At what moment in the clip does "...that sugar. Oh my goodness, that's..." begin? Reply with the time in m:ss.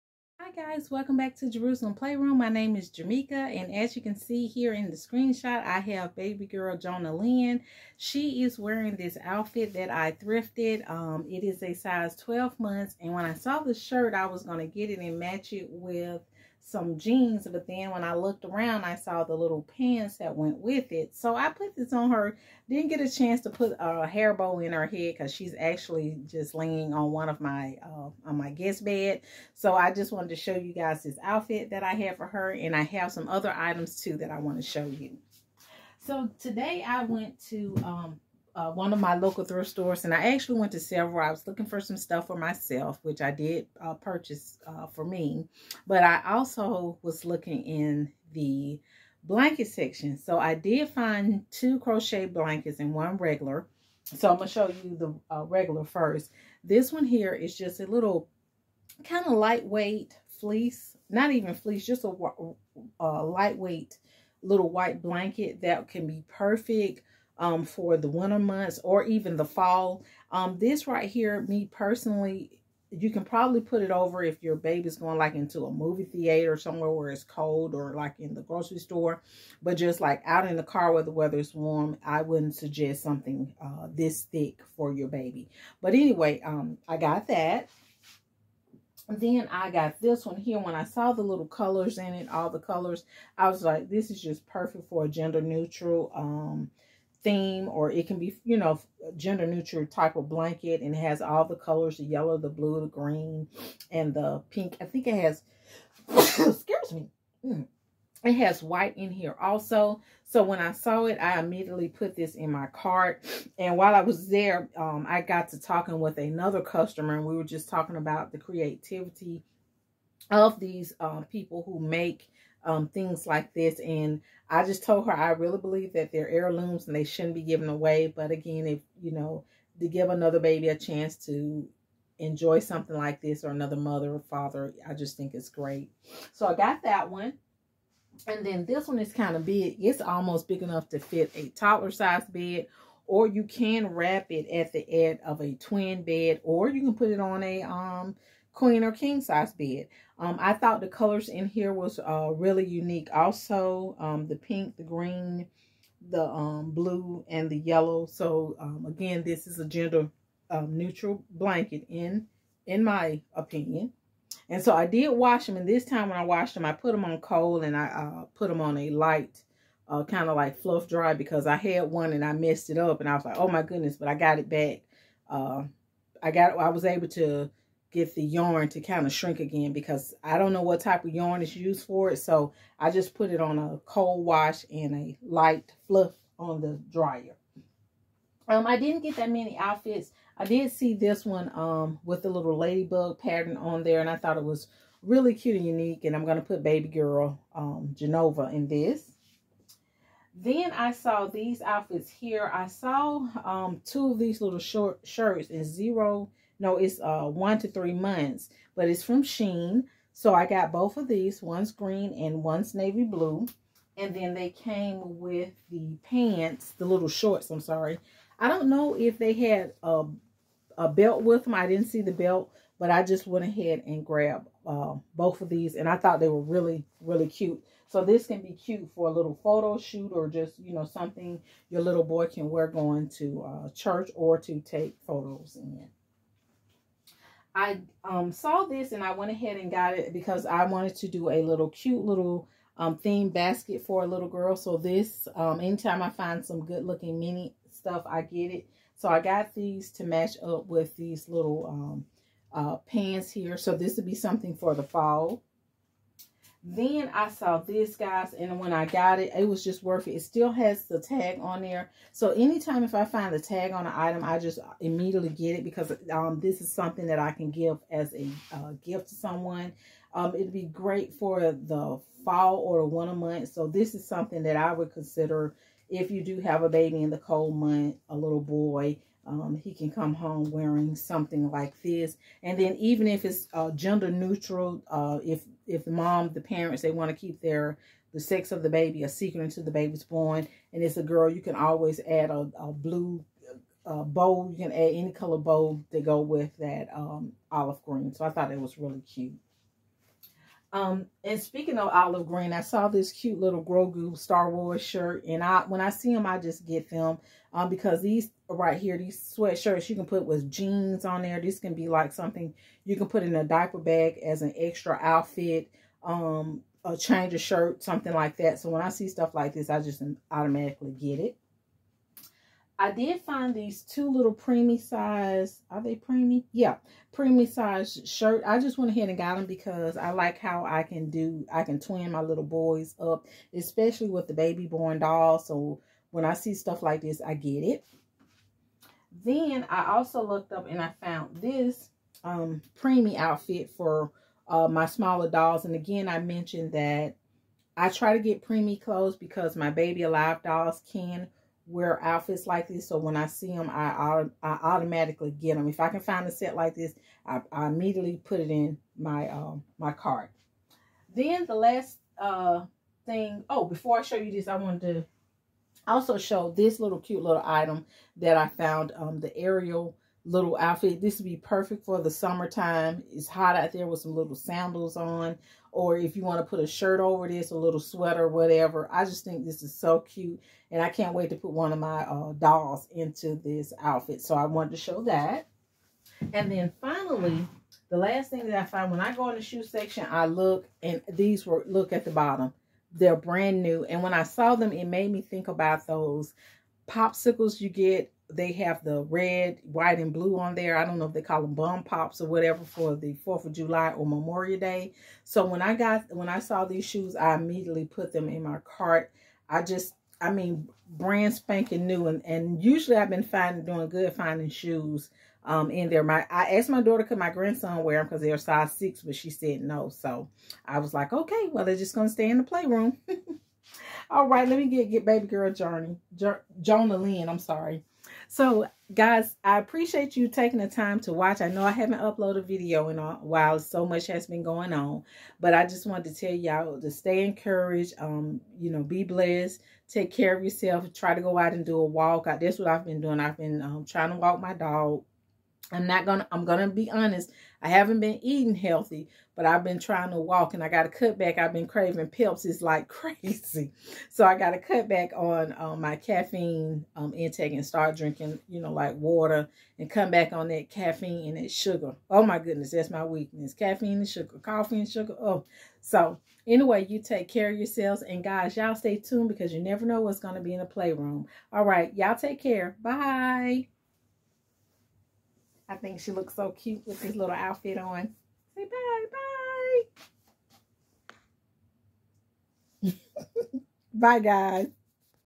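7:41.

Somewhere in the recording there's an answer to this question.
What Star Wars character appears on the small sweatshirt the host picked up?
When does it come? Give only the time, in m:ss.
5:03.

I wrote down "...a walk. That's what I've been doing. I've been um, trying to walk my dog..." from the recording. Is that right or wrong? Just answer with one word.
right.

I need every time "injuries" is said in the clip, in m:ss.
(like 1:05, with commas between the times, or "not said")
not said.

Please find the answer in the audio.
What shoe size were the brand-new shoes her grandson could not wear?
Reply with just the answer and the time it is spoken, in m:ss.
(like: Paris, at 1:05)
6, at 6:58.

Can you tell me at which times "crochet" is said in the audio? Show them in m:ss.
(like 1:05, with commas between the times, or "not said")
0:51.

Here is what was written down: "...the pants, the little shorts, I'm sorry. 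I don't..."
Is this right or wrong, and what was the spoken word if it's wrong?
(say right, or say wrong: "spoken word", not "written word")
right.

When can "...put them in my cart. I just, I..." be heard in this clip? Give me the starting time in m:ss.
6:47.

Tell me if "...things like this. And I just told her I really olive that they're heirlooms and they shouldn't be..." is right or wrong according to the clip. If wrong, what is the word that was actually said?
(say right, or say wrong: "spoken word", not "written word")
wrong: "believe", not "olive".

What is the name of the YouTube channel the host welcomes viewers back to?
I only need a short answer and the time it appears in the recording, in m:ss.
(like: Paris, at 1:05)
Jerusalem Playroom, at 0:01.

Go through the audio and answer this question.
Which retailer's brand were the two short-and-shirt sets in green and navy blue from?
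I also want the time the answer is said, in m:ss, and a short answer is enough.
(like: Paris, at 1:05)
Shein, at 3:29.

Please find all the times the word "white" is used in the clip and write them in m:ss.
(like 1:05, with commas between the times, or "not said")
1:04, 1:48, 6:39.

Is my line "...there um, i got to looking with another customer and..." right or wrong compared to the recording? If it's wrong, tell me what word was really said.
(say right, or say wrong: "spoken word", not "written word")
wrong: "talking", not "looking".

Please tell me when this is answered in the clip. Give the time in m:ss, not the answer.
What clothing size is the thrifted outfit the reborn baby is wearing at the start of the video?
0:11.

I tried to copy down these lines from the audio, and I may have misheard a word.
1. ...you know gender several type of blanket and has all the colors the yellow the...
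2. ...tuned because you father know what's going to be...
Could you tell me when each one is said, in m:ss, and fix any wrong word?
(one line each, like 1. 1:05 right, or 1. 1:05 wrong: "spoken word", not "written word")
1. 1:38 wrong: "neutral", not "several"
2. 7:48 wrong: "never", not "father".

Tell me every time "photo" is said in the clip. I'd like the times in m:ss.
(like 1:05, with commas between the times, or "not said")
3:49, 3:55.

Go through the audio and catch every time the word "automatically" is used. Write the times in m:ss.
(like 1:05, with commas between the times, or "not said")
5:20, 5:54.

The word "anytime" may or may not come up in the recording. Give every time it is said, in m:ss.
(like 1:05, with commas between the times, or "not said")
4:05, 4:22.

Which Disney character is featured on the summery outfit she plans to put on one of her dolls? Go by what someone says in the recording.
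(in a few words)
Ariel.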